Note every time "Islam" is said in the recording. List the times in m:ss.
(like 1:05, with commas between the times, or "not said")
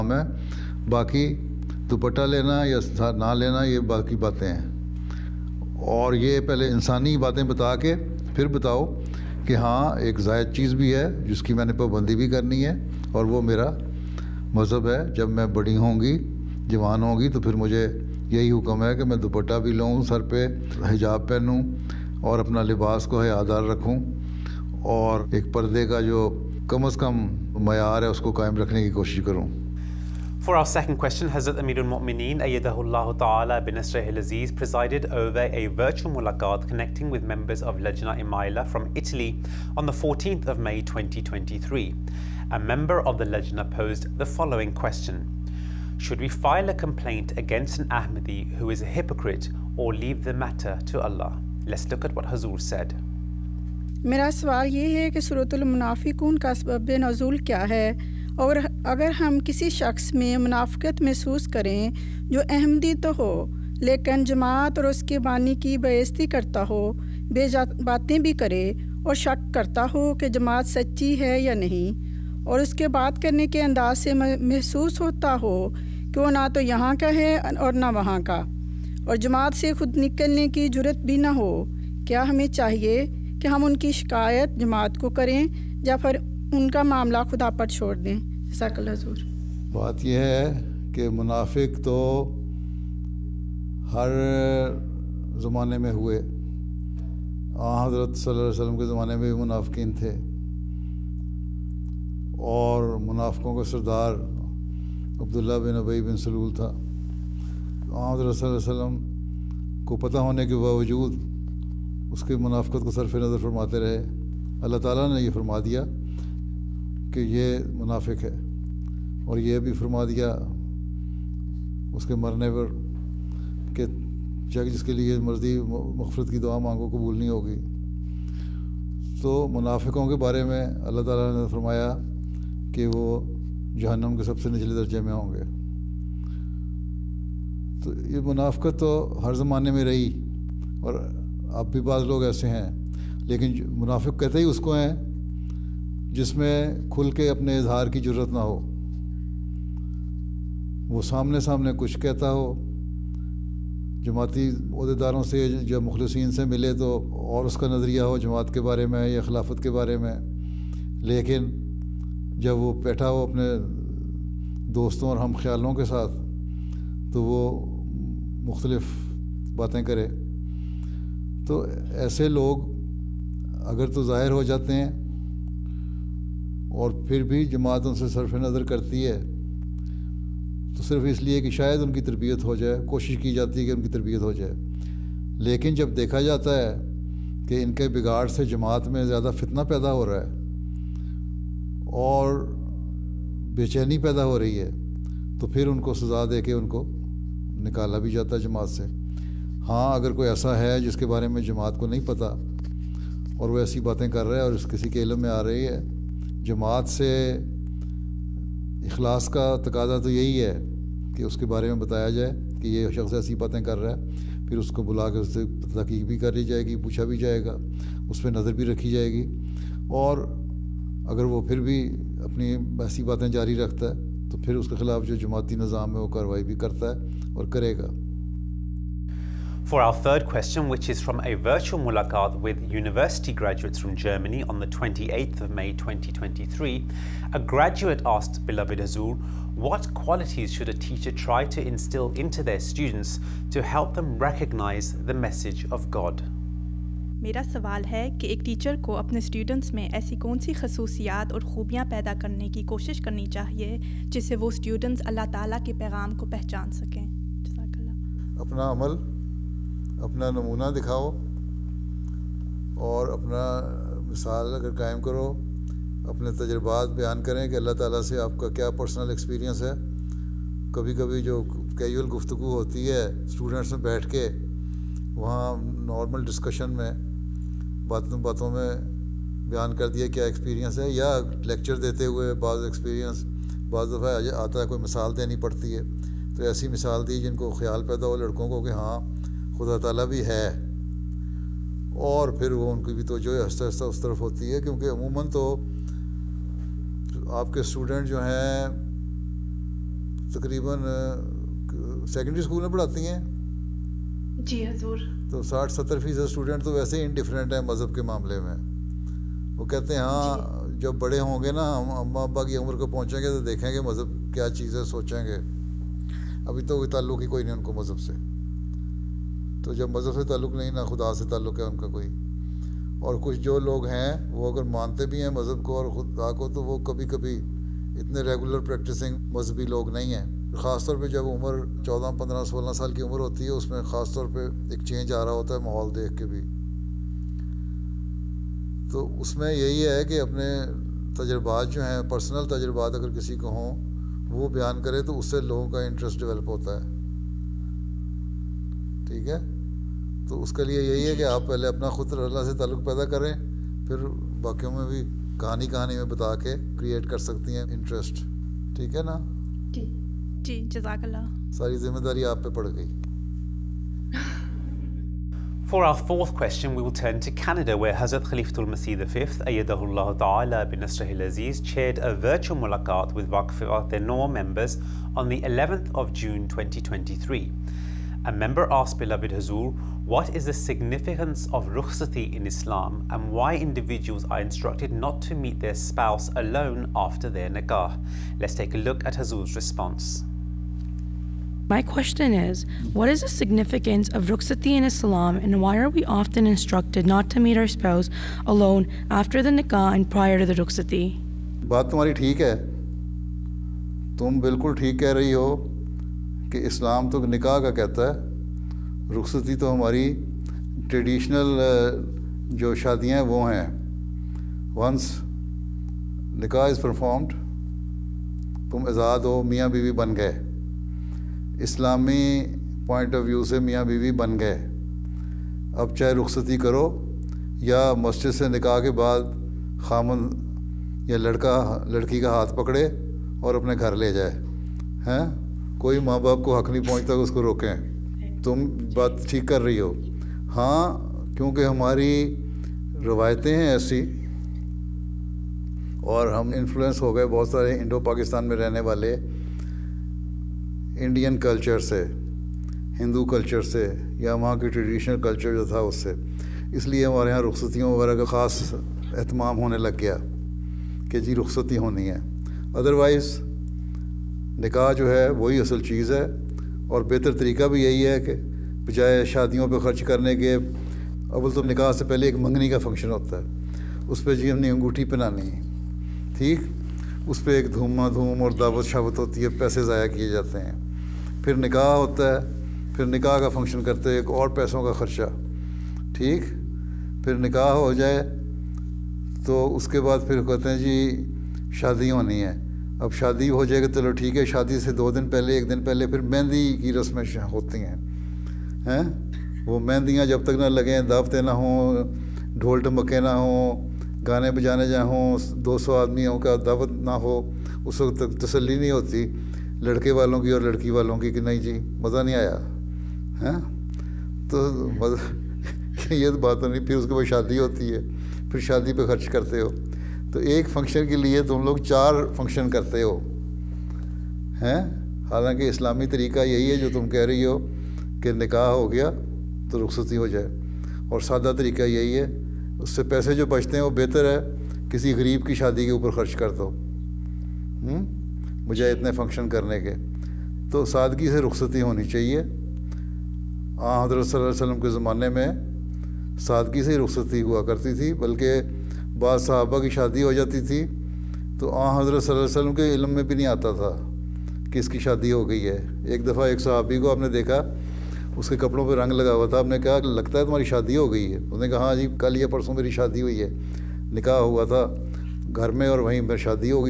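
6:22, 6:34.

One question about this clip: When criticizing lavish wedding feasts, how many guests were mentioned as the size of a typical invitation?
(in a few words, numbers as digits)
200.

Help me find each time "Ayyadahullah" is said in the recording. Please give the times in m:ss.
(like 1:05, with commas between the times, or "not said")
0:32, 6:09.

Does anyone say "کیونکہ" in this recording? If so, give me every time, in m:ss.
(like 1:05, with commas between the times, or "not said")
4:54, 7:21.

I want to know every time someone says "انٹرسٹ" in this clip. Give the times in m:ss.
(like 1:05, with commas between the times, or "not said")
5:45, 5:57.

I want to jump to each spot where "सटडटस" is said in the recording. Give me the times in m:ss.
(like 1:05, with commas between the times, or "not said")
4:09, 4:14.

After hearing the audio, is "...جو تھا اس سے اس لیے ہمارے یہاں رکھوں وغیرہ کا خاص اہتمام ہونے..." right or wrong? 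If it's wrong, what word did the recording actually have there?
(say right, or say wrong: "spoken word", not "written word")
wrong: "رخصتیوں", not "رکھوں".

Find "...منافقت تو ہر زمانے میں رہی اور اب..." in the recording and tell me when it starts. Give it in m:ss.
2:18.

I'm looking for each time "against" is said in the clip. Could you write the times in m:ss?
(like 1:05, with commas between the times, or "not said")
0:47.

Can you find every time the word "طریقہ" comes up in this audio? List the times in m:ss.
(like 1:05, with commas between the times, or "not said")
7:47, 8:46, 8:51.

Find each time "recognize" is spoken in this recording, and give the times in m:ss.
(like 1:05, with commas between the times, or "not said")
4:04.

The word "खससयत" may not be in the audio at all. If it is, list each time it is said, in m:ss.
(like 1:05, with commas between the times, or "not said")
4:10.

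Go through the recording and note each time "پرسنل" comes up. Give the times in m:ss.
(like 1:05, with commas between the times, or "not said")
4:28, 5:42.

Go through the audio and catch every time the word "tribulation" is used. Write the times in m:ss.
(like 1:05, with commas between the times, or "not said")
not said.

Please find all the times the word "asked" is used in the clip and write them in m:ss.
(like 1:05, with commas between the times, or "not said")
3:58, 6:18.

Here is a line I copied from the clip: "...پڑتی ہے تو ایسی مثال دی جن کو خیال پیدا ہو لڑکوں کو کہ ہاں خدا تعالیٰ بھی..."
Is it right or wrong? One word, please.
right.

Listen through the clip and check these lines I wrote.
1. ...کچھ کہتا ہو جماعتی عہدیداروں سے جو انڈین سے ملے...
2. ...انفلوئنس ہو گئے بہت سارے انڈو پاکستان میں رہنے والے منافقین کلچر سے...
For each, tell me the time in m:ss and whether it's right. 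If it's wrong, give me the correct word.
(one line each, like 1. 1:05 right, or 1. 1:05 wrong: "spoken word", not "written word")
1. 2:31 wrong: "مخلصین", not "انڈین"
2. 7:26 wrong: "انڈین", not "منافقین".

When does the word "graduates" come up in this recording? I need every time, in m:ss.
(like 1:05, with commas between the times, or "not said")
3:53, 3:57.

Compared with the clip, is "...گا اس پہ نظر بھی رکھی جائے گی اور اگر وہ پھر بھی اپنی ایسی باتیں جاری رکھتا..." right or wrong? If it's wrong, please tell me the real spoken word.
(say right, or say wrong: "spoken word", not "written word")
right.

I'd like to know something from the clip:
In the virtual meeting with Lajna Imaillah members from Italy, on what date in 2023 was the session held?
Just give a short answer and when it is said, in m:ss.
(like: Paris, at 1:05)
14 May 2023, at 0:39.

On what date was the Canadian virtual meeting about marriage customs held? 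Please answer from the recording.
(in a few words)
11 June 2023.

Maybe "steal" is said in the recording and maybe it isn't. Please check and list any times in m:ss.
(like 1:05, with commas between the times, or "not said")
not said.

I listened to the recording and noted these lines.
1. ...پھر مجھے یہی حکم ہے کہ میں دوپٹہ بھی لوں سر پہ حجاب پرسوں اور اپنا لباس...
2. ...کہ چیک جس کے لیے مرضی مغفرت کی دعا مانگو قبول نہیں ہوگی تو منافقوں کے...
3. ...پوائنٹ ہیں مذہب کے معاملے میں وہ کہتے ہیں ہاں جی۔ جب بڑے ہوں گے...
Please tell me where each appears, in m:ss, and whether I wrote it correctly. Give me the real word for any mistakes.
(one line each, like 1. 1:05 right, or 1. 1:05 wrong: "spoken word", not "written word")
1. 0:17 wrong: "پہنوں", not "پرسوں"
2. 2:03 right
3. 5:07 wrong: "انڈیفرنٹ", not "پوائنٹ".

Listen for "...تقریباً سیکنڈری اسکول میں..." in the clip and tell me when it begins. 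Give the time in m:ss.
5:00.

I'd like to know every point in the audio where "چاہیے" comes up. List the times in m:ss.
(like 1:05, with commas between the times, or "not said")
1:22, 9:02.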